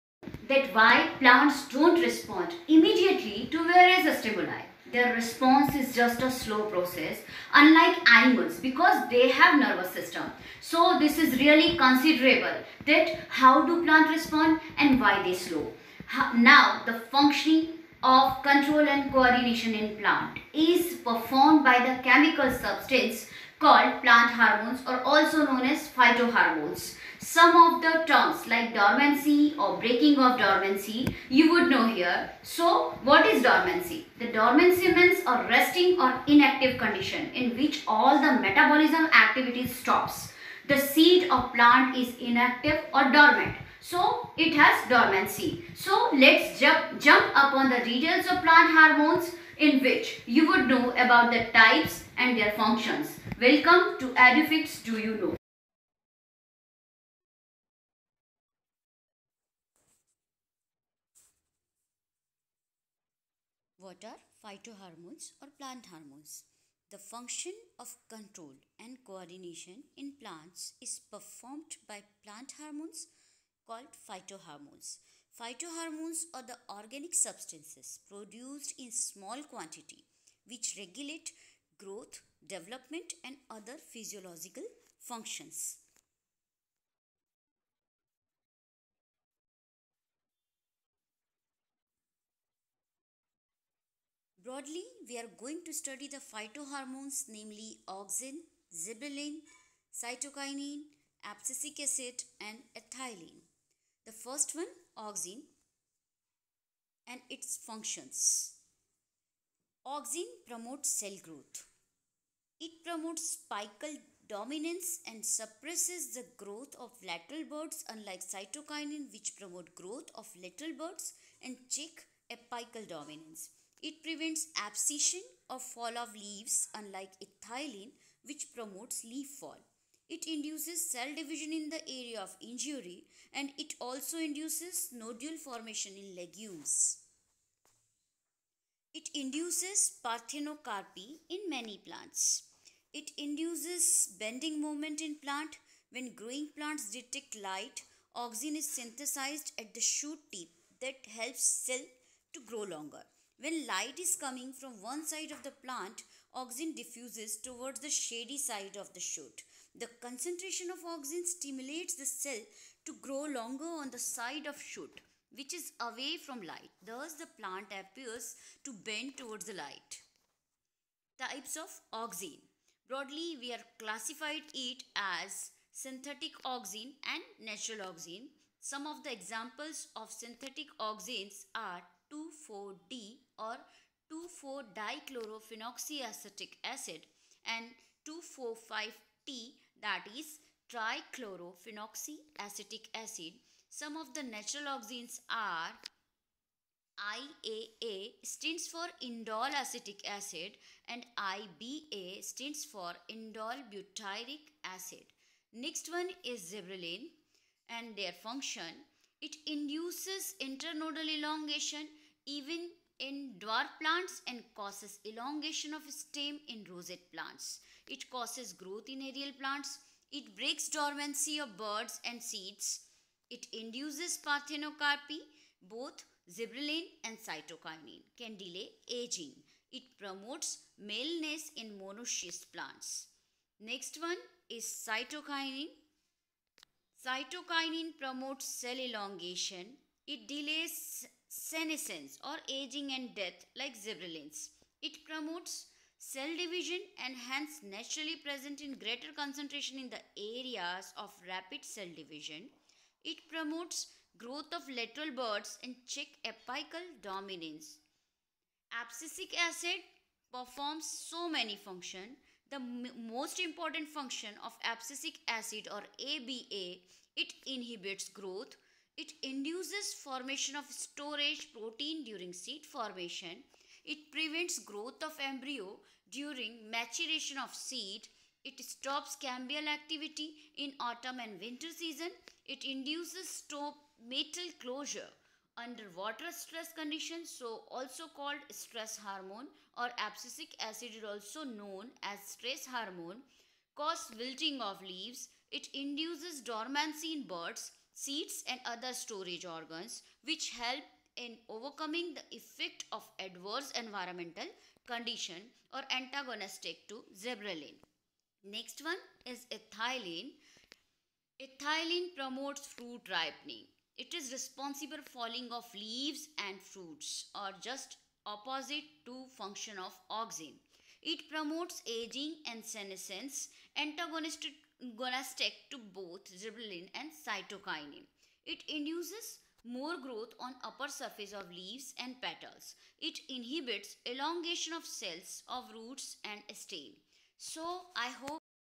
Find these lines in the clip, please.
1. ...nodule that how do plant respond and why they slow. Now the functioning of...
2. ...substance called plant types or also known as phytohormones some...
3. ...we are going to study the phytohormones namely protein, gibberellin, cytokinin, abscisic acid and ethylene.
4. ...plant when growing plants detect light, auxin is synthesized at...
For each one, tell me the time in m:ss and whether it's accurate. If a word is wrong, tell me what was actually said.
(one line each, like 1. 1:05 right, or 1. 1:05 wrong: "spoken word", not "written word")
1. 0:11 wrong: "considerable", not "nodule"
2. 0:22 wrong: "hormones", not "types"
3. 1:35 wrong: "auxin", not "protein"
4. 2:25 right.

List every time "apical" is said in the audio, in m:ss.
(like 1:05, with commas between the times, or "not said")
1:53, 2:02, 4:16.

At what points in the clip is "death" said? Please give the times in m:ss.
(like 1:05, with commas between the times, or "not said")
4:03.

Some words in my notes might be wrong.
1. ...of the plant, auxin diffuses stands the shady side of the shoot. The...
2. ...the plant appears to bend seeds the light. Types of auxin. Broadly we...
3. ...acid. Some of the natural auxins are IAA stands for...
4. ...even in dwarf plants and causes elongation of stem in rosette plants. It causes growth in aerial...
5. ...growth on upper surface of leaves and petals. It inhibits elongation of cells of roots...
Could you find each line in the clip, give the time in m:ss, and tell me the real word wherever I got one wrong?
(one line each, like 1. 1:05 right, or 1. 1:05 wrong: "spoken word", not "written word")
1. 2:35 wrong: "towards", not "stands"
2. 2:47 wrong: "towards", not "seeds"
3. 3:12 right
4. 3:32 right
5. 5:30 right.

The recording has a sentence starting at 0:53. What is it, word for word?
Welcome to Edufacts Do You Know.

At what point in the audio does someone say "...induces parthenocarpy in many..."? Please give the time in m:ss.
2:19.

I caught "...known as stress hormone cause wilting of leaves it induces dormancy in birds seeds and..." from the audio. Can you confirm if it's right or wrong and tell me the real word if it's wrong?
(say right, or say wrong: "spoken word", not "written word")
right.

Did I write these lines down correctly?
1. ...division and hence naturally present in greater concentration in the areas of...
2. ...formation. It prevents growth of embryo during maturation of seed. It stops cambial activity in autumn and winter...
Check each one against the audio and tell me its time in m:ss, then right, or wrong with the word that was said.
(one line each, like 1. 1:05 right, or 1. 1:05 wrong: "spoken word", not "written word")
1. 4:06 right
2. 4:32 right.